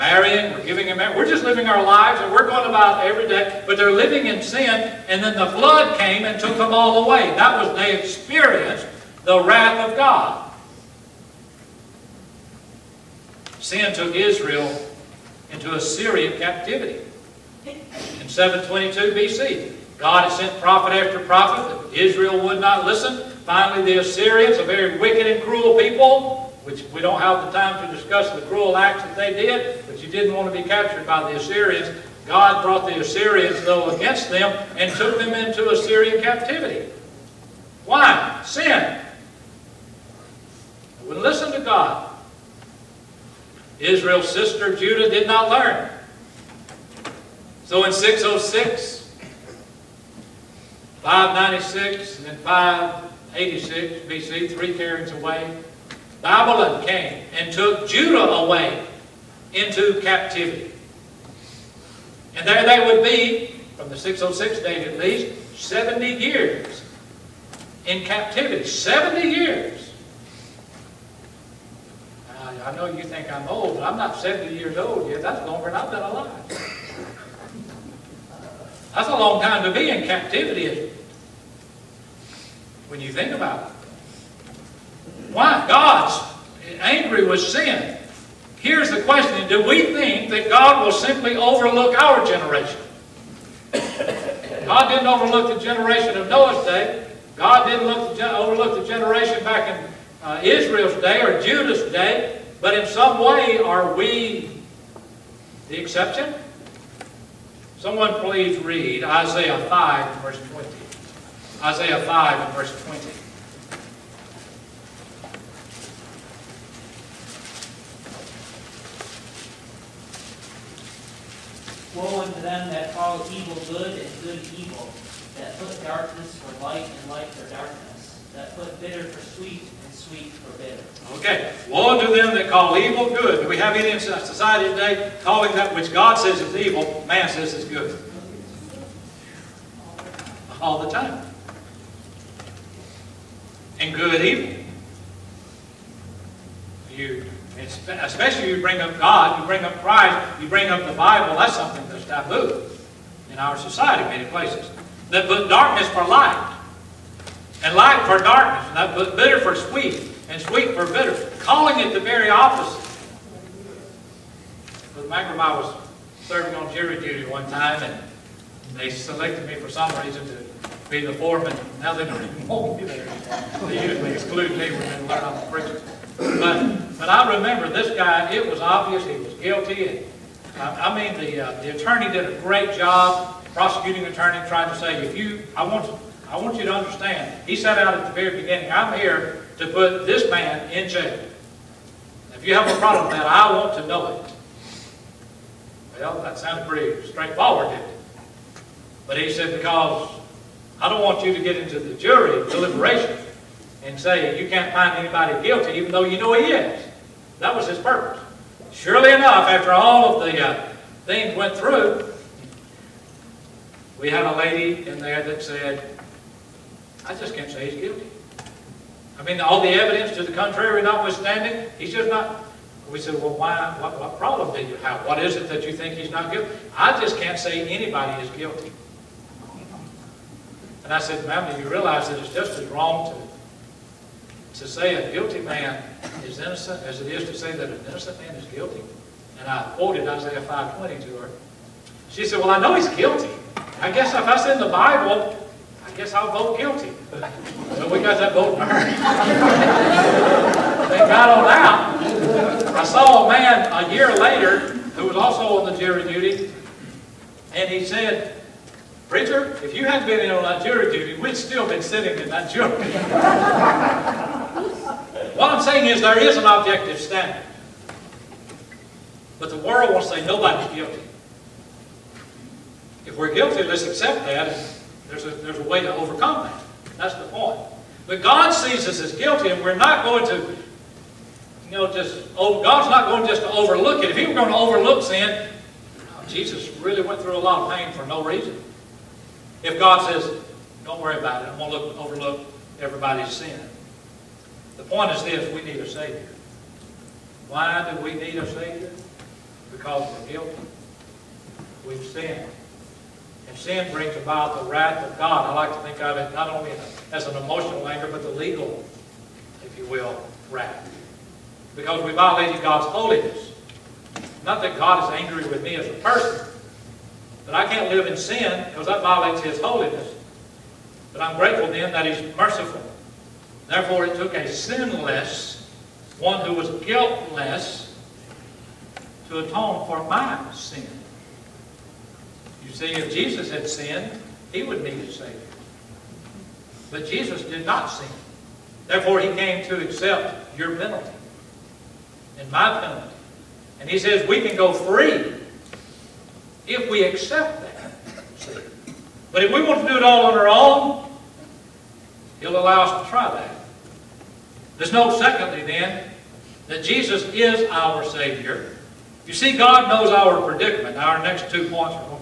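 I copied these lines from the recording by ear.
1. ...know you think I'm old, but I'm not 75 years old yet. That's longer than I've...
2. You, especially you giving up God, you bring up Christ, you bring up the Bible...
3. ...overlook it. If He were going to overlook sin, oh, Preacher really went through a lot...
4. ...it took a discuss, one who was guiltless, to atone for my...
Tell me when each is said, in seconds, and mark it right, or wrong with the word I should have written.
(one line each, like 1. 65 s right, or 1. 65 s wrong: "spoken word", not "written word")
1. 72 s wrong: "70", not "75"
2. 146 s wrong: "bring", not "giving"
3. 283 s wrong: "Jesus", not "Preacher"
4. 324 s wrong: "sinless", not "discuss".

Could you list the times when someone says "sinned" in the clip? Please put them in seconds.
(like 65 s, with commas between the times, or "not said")
302 s, 333 s.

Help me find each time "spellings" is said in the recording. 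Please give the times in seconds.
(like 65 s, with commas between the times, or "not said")
not said.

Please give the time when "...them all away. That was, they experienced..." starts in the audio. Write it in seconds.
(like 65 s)
6 s.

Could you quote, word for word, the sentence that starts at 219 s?
I mean, all the evidence to the contrary notwithstanding, he's just not.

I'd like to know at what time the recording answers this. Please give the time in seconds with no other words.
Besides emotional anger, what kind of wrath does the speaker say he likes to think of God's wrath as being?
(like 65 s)
308 s.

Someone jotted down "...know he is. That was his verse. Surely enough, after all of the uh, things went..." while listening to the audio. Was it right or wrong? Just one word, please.
wrong.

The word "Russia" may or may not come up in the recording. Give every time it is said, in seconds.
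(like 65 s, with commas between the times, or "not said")
not said.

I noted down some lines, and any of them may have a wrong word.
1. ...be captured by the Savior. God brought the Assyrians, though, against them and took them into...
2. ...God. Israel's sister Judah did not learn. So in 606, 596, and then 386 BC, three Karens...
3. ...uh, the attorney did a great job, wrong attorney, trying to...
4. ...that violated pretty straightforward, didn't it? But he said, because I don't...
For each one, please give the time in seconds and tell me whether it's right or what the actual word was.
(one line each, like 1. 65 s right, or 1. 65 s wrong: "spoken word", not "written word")
1. 30 s wrong: "Assyrians", not "Savior"
2. 41 s wrong: "586", not "386"
3. 181 s wrong: "prosecuting", not "wrong"
4. 196 s wrong: "sounded", not "violated".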